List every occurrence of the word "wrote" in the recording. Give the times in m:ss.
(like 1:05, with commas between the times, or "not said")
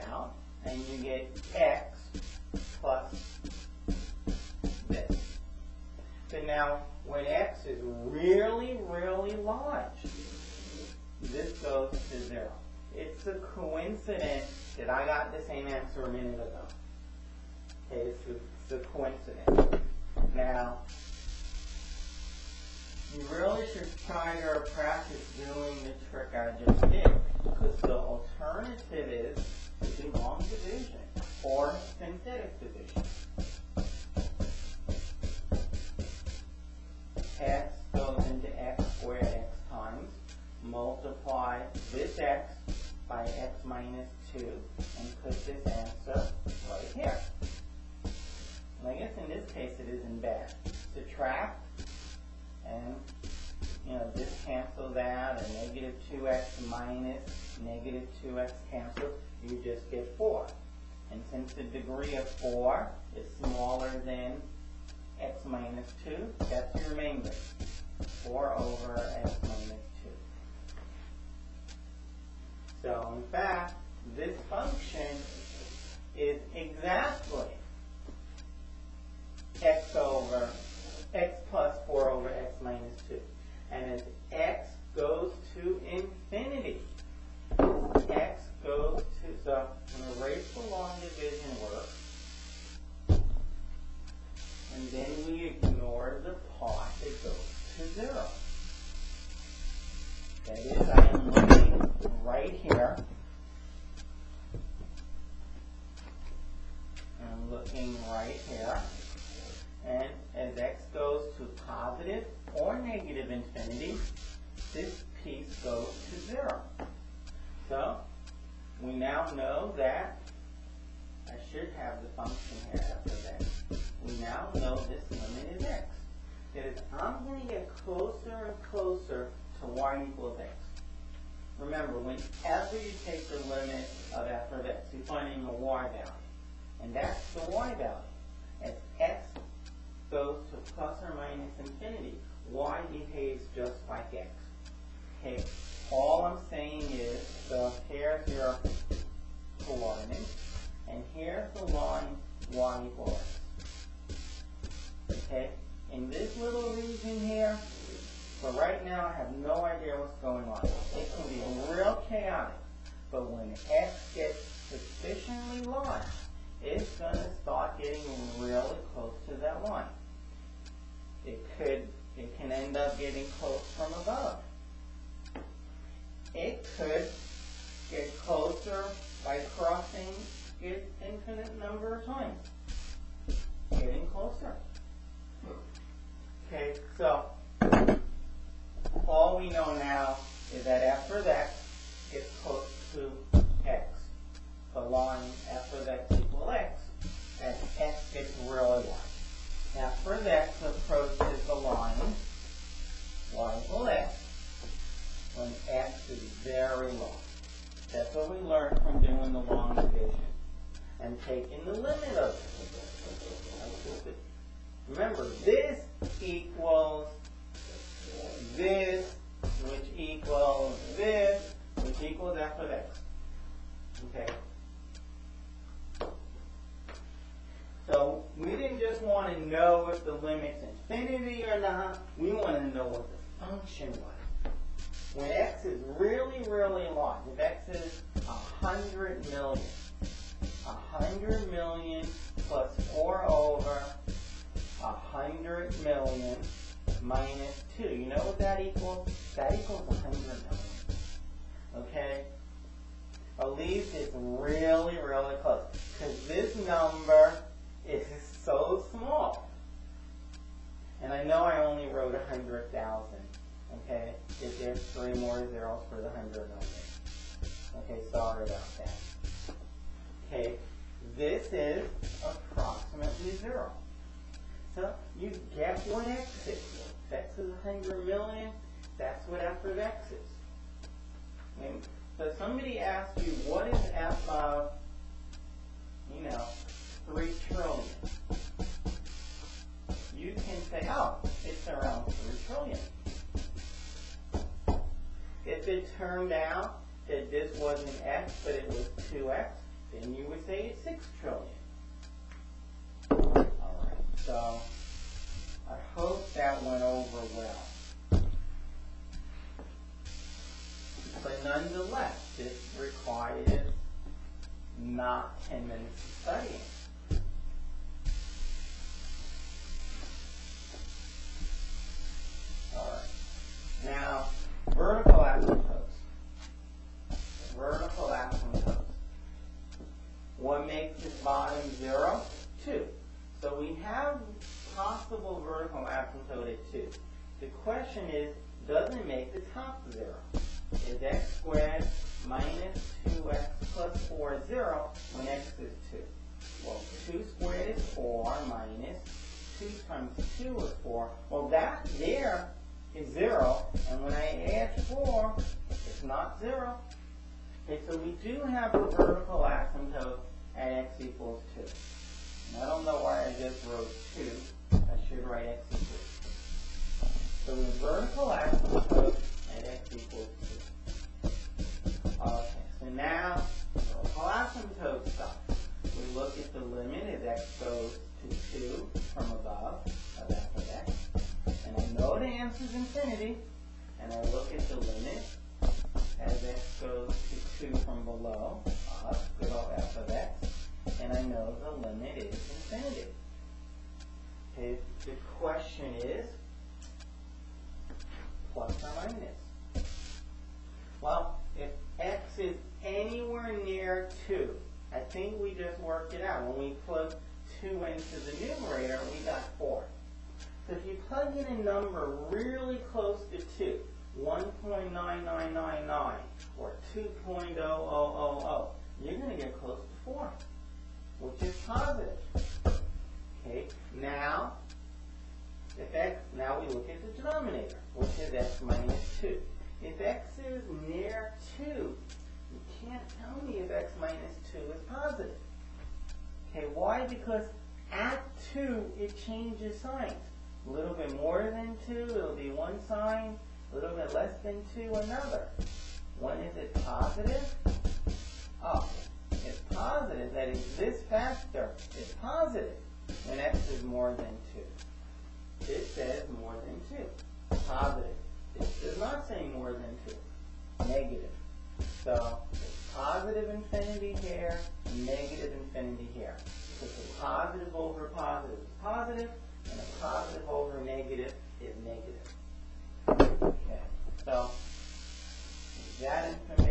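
4:21, 6:03.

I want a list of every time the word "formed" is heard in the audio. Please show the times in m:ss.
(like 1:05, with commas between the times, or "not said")
not said.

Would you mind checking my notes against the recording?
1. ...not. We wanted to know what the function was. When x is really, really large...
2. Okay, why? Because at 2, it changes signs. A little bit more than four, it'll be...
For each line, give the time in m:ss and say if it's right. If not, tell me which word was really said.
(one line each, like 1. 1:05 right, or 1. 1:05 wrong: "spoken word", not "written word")
1. 3:51 right
2. 7:16 wrong: "two", not "four".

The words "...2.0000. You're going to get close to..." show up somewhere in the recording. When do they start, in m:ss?
6:56.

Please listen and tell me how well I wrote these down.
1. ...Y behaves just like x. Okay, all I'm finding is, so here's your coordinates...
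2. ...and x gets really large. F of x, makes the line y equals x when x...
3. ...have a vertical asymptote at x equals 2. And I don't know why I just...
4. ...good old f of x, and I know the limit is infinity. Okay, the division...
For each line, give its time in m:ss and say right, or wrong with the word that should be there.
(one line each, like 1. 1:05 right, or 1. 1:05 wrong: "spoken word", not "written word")
1. 2:22 wrong: "saying", not "finding"
2. 3:17 wrong: "approaches", not "makes"
3. 5:58 right
4. 6:29 wrong: "question", not "division".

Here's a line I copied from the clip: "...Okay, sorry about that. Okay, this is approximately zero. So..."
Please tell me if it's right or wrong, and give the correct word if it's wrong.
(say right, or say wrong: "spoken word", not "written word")
right.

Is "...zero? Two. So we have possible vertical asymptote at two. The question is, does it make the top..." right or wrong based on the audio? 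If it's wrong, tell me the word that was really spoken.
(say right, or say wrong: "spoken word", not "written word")
right.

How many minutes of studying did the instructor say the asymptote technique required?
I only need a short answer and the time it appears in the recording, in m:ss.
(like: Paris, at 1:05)
10, at 5:15.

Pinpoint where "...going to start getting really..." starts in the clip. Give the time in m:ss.
2:46.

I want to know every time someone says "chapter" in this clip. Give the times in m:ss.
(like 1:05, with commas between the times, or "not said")
not said.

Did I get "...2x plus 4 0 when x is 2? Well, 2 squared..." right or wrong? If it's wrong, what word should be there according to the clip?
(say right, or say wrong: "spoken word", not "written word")
right.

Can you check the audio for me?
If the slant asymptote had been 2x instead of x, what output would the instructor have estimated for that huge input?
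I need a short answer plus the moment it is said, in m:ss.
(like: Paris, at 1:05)
6 trillion, at 5:00.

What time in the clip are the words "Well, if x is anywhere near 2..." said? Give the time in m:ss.
6:41.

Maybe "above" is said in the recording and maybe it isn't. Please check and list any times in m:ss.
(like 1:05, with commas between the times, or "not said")
2:53, 6:19.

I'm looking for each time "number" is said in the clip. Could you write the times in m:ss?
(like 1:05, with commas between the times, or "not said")
3:01, 4:16, 6:51.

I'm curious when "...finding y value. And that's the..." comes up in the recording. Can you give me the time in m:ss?
2:15.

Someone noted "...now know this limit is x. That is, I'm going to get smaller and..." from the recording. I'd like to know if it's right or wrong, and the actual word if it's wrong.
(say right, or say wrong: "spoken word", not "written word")
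wrong: "closer", not "smaller".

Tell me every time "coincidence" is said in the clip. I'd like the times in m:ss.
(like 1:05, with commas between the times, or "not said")
0:13, 0:18.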